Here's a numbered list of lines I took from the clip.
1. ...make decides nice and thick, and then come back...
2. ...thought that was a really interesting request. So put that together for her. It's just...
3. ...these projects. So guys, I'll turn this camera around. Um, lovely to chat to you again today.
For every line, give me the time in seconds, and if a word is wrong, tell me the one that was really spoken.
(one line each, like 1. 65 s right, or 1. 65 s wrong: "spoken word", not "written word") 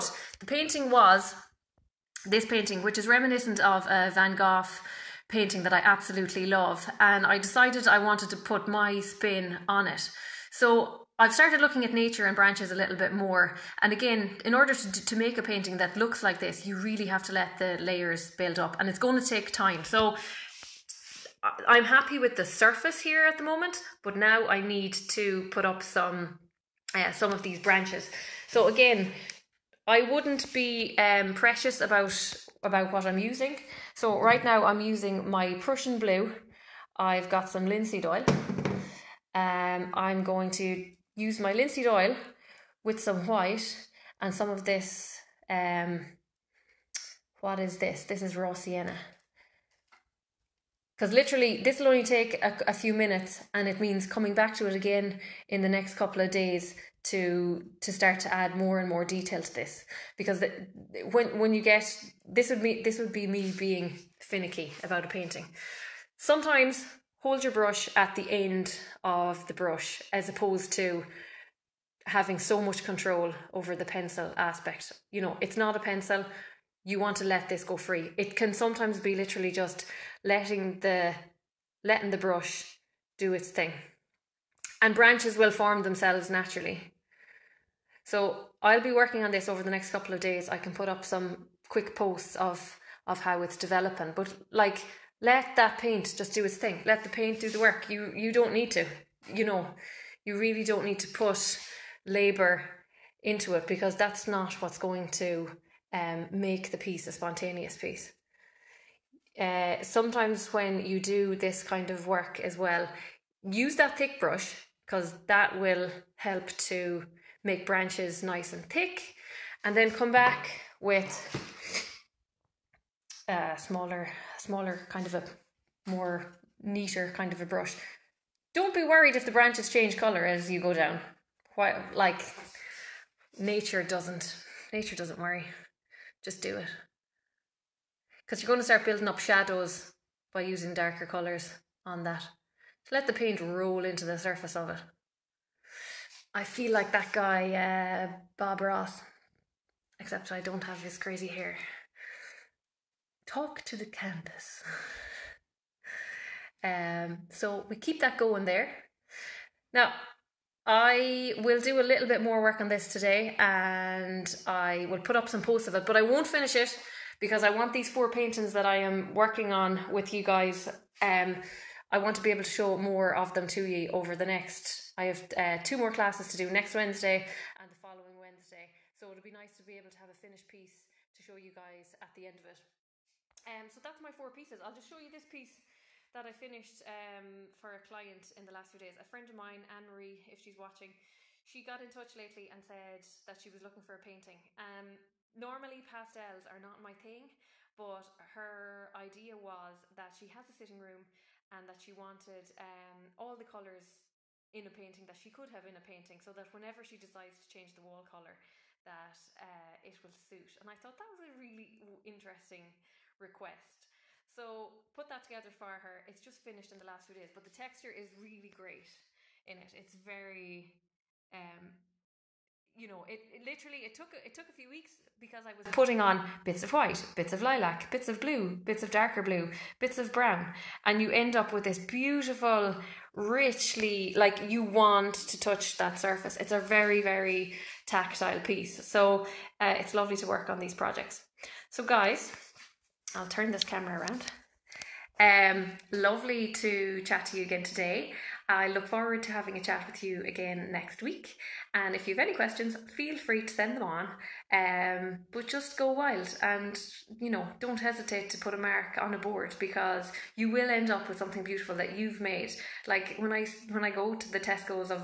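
1. 117 s wrong: "branches", not "decides"
2. 210 s right
3. 240 s right.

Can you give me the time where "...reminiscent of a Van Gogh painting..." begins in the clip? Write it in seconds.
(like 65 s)
3 s.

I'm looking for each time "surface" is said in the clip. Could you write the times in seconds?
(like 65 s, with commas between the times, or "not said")
22 s, 144 s, 235 s.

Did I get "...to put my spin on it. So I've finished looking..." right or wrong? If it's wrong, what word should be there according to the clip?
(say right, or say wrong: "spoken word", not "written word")
wrong: "started", not "finished".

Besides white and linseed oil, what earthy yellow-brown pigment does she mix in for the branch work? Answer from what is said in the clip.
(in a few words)
raw sienna.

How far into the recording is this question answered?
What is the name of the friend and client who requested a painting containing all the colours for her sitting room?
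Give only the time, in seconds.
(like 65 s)
189 s.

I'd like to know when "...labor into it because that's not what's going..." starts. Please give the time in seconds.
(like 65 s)
102 s.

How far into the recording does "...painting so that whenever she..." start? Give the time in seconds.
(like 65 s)
205 s.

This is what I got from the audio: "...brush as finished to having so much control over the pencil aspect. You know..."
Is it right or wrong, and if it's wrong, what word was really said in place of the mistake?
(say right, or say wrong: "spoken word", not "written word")
wrong: "opposed", not "finished".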